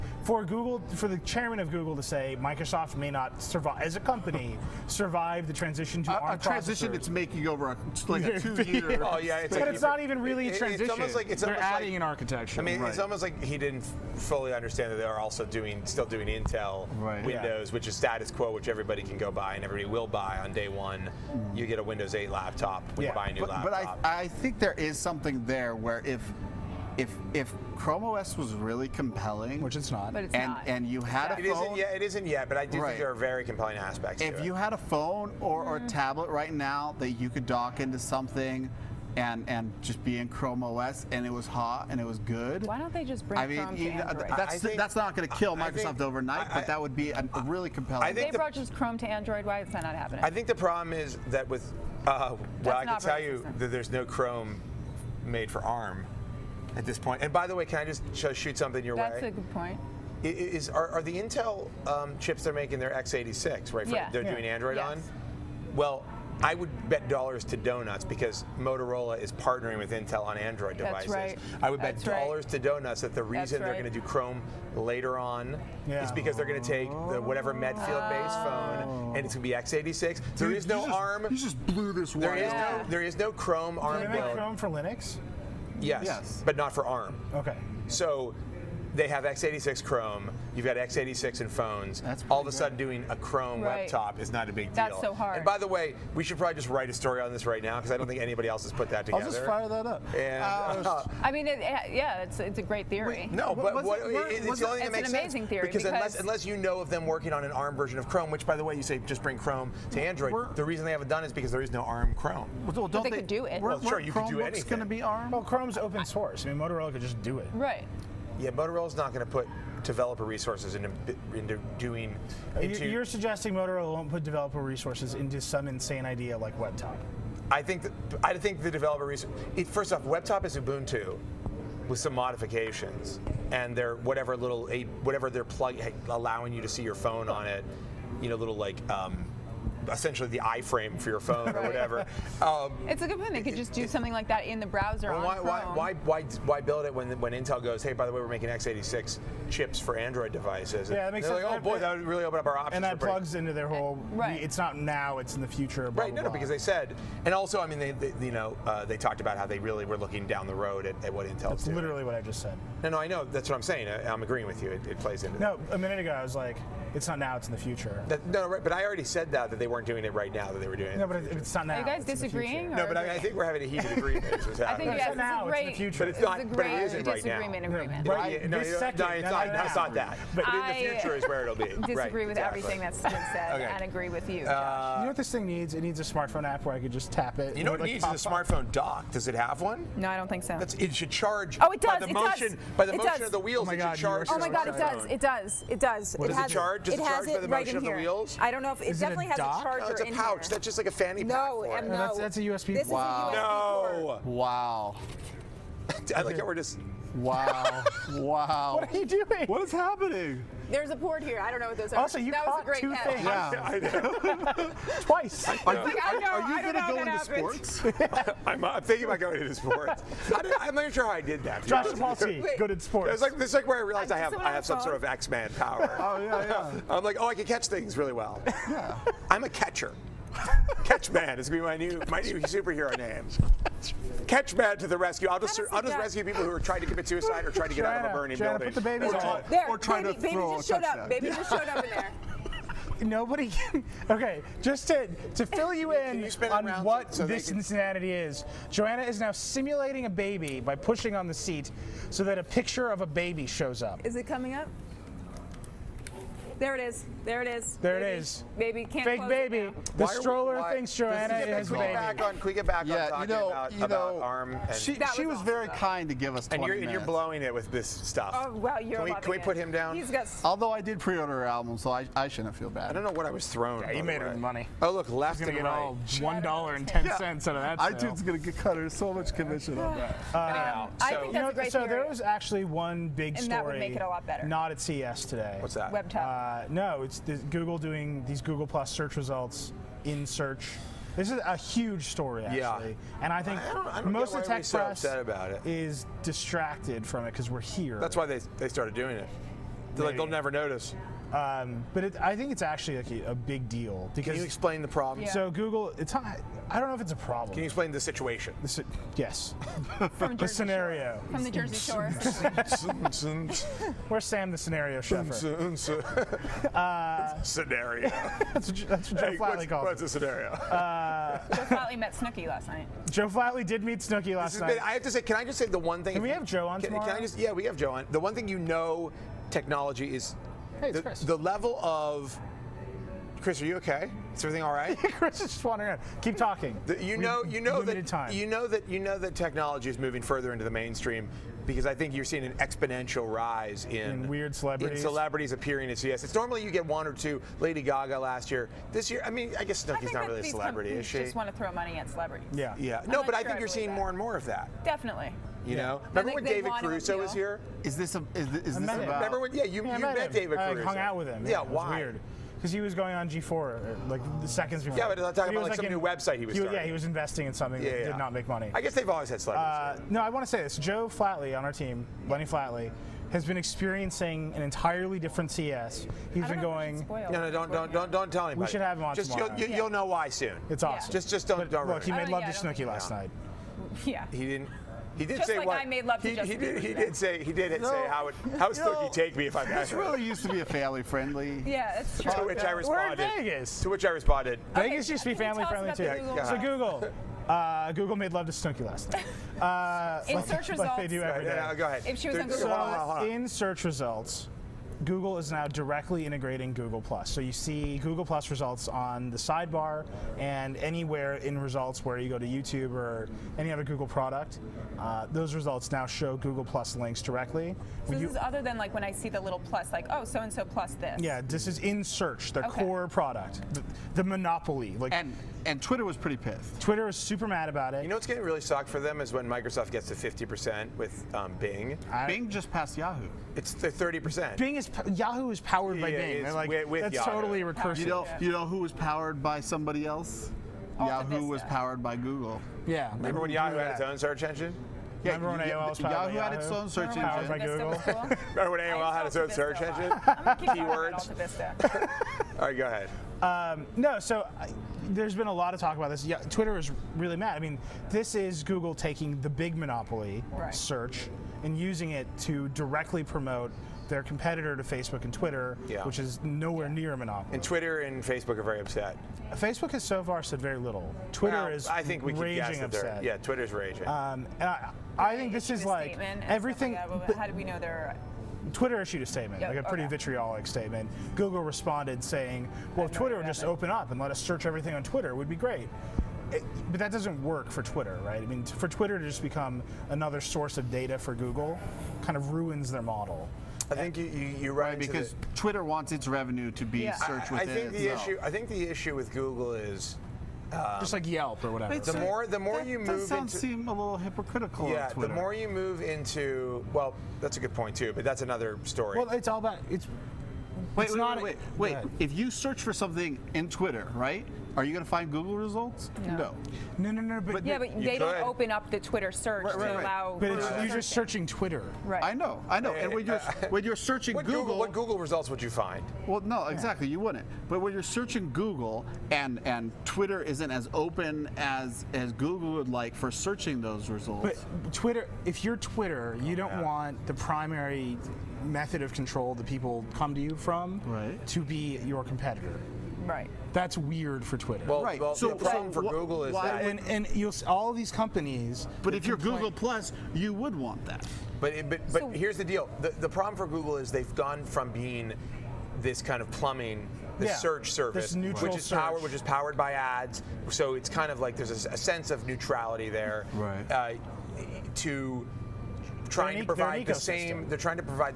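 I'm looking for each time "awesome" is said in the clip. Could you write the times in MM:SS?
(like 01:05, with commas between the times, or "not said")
04:25, 06:20.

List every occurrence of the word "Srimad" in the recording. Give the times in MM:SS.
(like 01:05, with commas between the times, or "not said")
not said.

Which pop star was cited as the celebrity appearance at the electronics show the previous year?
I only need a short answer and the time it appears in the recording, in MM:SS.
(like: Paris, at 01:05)
Lady Gaga, at 05:47.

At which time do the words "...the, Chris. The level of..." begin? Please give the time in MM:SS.
05:30.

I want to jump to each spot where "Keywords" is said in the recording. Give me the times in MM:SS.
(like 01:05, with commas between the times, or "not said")
07:30.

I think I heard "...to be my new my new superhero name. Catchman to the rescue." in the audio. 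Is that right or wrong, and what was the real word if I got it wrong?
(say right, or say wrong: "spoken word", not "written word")
right.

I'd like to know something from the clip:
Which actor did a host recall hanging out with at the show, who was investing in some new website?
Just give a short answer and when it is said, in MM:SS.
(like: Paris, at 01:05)
David Caruso, at 05:56.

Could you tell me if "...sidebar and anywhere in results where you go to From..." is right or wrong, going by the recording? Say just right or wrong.
wrong.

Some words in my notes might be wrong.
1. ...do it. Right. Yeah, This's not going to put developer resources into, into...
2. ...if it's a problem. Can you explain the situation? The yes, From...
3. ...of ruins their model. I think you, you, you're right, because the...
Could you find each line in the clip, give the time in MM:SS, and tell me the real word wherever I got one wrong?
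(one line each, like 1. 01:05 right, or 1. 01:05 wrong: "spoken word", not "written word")
1. 01:57 wrong: "Motorola", not "This"
2. 05:06 right
3. 08:12 right.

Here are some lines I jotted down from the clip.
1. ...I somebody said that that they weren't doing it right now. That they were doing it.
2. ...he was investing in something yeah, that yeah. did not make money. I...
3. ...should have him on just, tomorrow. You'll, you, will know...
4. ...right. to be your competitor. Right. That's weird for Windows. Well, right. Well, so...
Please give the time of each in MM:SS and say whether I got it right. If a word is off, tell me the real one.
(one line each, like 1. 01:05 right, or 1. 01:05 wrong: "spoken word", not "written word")
1. 02:48 wrong: "already", not "somebody"
2. 06:06 right
3. 06:18 right
4. 09:01 wrong: "Twitter", not "Windows".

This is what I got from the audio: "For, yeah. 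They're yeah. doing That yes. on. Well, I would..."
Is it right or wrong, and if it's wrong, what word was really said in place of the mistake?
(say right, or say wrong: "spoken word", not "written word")
wrong: "Android", not "That".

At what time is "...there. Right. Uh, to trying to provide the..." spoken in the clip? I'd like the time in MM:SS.
09:23.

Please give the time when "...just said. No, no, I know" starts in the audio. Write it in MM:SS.
02:42.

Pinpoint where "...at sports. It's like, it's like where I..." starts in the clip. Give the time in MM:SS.
03:42.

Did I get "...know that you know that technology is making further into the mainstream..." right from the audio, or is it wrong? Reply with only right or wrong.
wrong.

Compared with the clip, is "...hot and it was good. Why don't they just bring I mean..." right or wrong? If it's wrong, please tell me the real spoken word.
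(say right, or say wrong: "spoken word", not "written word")
right.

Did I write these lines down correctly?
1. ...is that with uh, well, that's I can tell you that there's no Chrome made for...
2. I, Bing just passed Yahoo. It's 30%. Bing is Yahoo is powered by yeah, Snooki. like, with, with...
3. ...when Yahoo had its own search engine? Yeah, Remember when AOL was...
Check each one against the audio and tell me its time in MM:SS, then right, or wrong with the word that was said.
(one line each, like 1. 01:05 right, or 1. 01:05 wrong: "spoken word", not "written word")
1. 00:50 right
2. 07:12 wrong: "Bing", not "Snooki"
3. 07:23 right.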